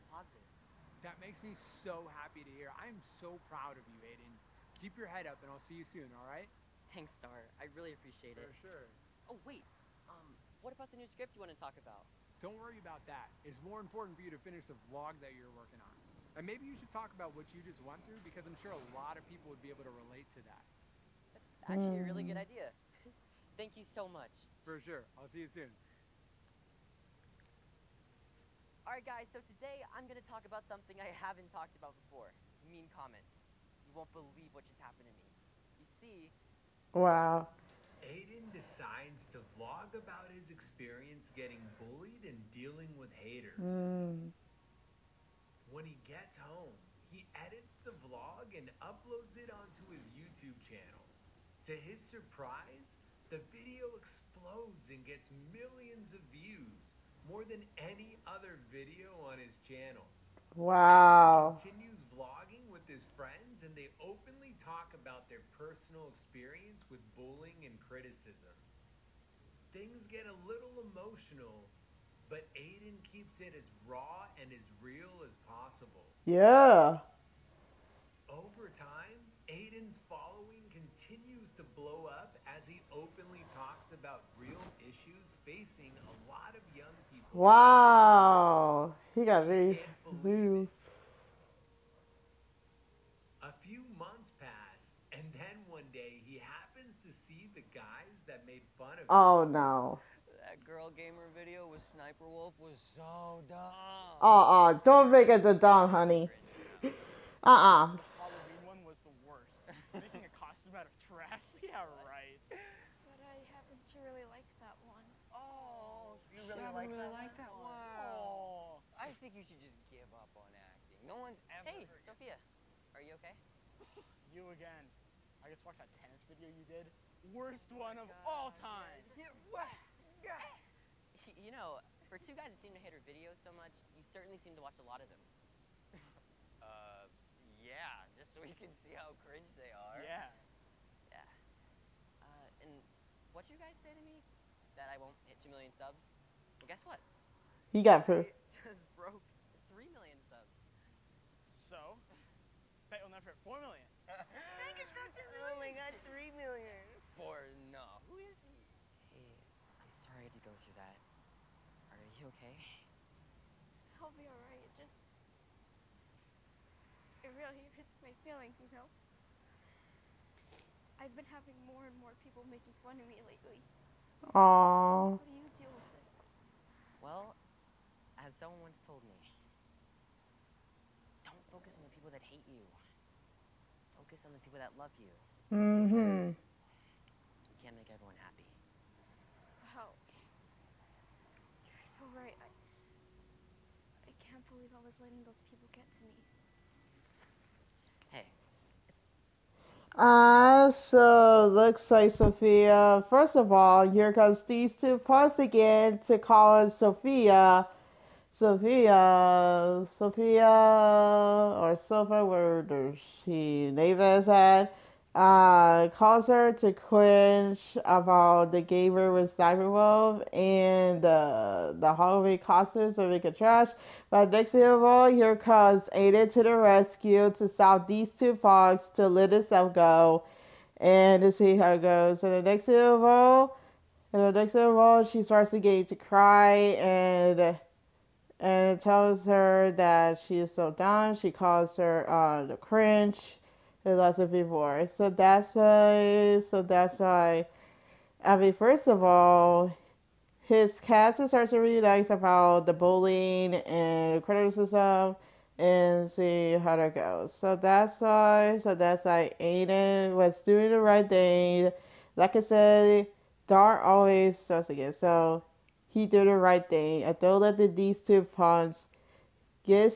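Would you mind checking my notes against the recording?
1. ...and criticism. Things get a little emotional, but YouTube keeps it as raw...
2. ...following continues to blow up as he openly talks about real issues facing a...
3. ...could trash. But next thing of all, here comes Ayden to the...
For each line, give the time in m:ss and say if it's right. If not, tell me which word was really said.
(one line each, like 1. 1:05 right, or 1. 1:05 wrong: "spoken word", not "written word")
1. 1:07 wrong: "Ayden", not "YouTube"
2. 1:20 right
3. 3:43 right.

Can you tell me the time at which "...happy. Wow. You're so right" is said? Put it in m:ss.
3:08.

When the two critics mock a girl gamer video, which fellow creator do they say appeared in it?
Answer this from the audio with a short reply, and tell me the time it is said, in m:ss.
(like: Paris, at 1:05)
Sniper Wolf, at 1:41.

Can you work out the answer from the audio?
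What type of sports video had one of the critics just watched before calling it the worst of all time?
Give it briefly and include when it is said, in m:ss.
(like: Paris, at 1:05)
Tennis, at 2:05.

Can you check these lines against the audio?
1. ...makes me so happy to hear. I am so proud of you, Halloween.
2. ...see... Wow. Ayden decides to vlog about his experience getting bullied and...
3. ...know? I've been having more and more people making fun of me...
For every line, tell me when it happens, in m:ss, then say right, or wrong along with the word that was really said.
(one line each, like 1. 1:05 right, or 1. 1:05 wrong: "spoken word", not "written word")
1. 0:01 wrong: "Ayden", not "Halloween"
2. 0:36 right
3. 2:48 right.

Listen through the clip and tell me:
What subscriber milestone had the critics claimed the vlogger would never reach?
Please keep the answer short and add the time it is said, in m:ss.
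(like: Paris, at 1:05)
2 million, at 2:25.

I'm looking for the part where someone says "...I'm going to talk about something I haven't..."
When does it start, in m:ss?
0:29.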